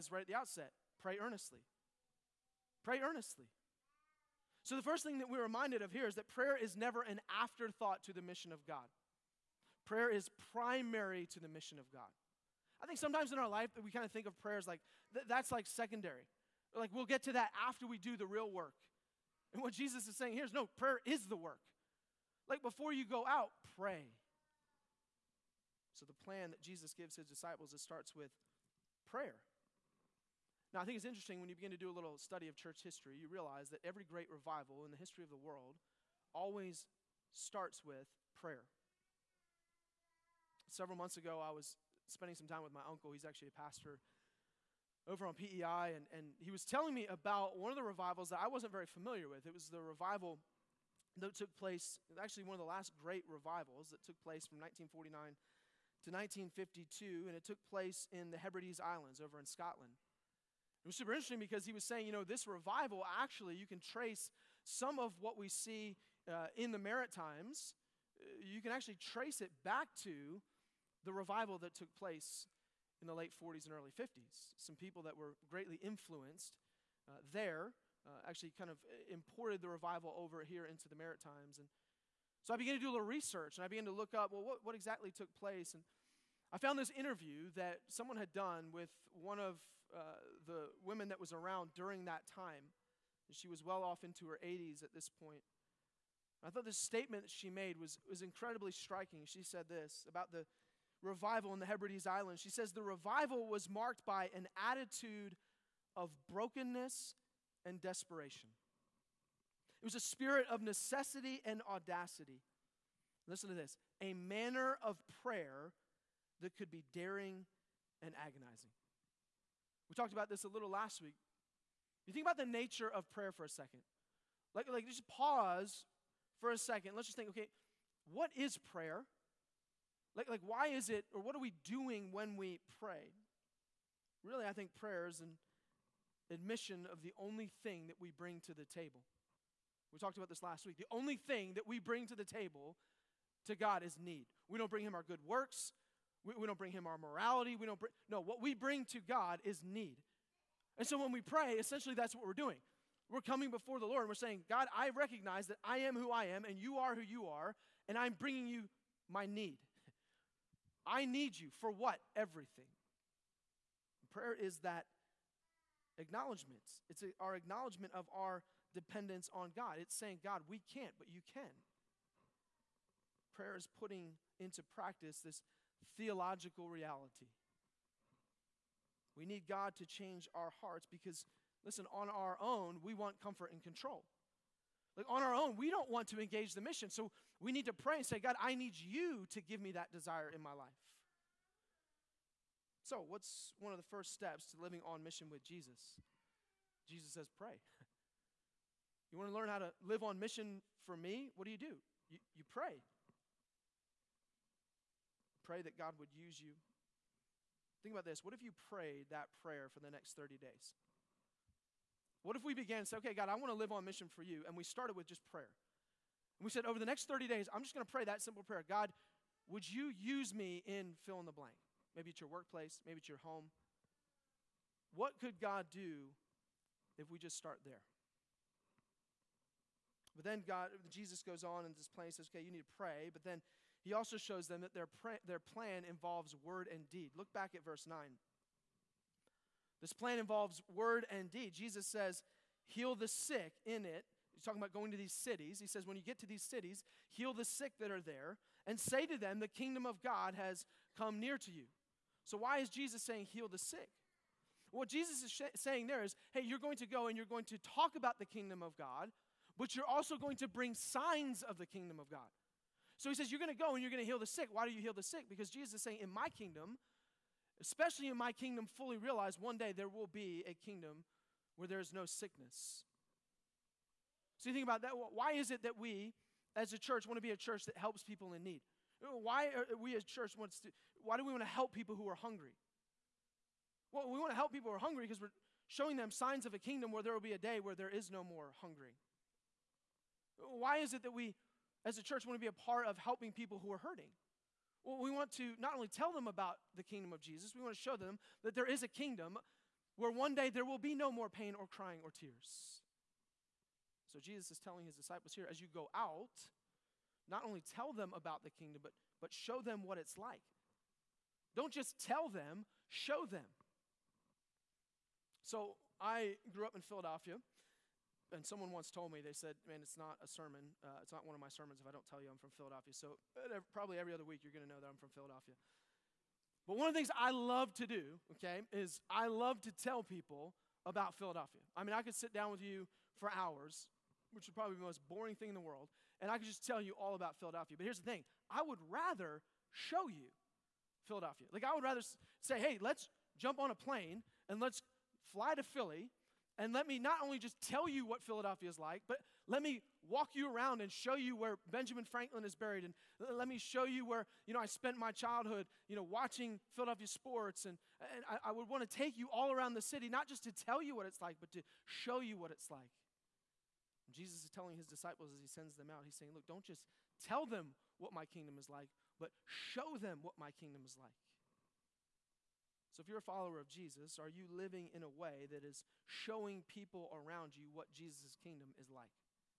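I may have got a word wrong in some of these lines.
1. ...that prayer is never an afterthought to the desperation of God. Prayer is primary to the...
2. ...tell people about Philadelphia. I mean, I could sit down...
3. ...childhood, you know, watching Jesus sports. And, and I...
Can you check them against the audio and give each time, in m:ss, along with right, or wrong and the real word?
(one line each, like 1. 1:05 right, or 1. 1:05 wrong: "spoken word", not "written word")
1. 0:06 wrong: "mission", not "desperation"
2. 5:29 right
3. 5:55 wrong: "Philadelphia", not "Jesus".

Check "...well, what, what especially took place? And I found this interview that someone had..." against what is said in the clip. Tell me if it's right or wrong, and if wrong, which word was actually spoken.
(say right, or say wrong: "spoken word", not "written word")
wrong: "exactly", not "especially".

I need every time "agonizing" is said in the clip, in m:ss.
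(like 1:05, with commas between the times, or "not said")
1:58.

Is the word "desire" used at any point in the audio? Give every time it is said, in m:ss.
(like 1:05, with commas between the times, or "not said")
3:09.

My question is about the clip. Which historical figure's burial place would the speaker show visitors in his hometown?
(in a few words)
Benjamin Franklin.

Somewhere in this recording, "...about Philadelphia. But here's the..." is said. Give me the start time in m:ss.
5:37.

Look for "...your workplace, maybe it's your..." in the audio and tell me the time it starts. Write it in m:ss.
3:42.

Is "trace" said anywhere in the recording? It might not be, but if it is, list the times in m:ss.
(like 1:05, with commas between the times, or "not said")
1:03, 1:08.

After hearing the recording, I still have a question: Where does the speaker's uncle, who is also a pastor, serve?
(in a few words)
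PEI.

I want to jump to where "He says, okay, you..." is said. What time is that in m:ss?
3:52.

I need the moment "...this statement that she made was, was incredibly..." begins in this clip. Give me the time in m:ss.
1:36.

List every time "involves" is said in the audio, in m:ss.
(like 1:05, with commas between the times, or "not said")
3:55, 4:00.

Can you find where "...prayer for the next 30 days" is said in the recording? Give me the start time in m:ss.
3:29.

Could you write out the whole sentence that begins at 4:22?
So he says, You're going to go and you're going to heal the sick.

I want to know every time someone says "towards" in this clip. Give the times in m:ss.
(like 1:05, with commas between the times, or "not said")
not said.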